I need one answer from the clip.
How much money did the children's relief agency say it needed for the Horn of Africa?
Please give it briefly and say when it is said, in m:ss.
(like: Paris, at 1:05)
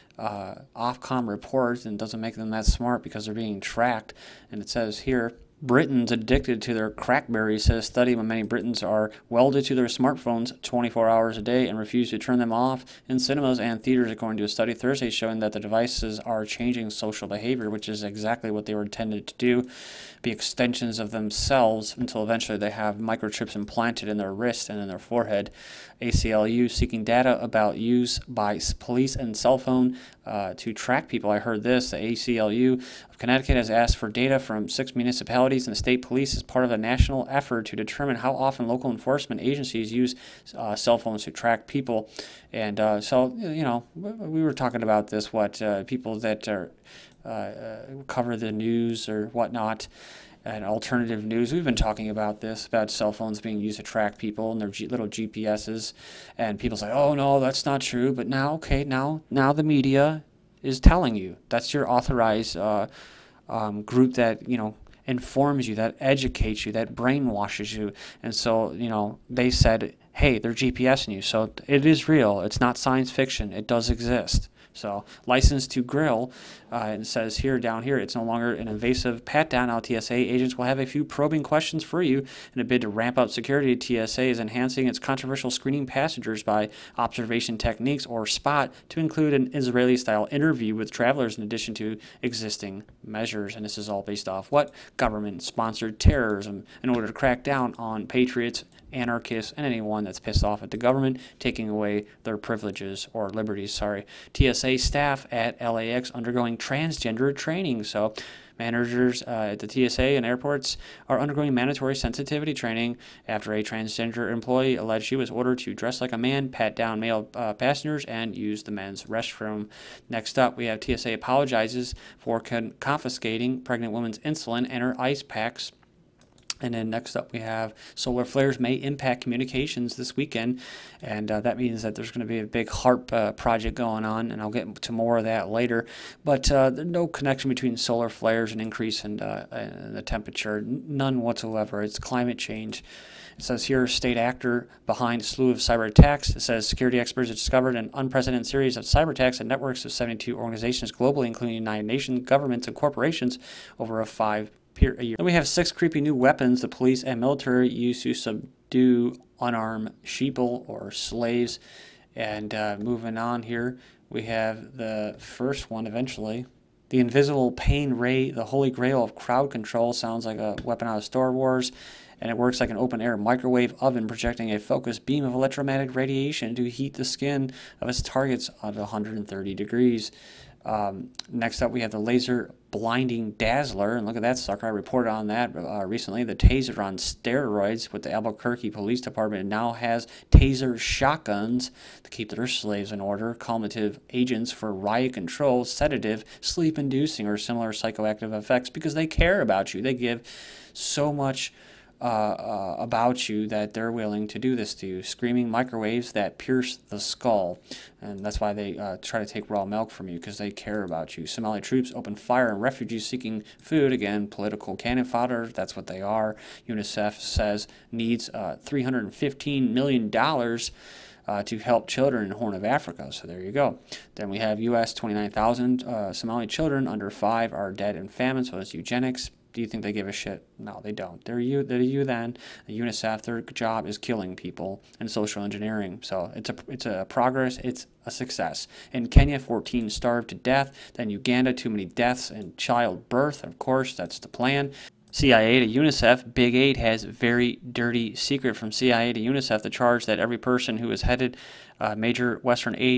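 $315 million, at 3:38.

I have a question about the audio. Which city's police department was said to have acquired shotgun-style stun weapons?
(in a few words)
Albuquerque.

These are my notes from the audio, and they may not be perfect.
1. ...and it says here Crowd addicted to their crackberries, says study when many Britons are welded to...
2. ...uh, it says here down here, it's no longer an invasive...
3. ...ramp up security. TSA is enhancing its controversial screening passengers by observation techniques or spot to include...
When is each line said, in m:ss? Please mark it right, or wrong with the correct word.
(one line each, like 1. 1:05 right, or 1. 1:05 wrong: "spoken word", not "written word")
1. 0:04 wrong: "Britons", not "Crowd"
2. 1:16 right
3. 1:22 right.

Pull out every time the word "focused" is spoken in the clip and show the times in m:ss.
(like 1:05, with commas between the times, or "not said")
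2:54.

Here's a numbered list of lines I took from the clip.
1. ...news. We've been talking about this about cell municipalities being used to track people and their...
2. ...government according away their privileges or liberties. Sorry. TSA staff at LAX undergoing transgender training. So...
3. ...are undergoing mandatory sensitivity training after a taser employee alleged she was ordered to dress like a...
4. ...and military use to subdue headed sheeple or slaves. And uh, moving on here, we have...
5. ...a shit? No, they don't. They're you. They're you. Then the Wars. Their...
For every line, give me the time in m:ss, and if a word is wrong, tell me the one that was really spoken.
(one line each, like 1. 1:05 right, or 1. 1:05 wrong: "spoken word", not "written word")
1. 0:51 wrong: "phones", not "municipalities"
2. 1:40 wrong: "taking", not "according"
3. 1:51 wrong: "transgender", not "taser"
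4. 2:37 wrong: "unarmed", not "headed"
5. 3:50 wrong: "UNICEF", not "Wars".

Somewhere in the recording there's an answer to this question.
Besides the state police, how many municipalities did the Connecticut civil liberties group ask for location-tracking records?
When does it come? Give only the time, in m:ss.
0:34.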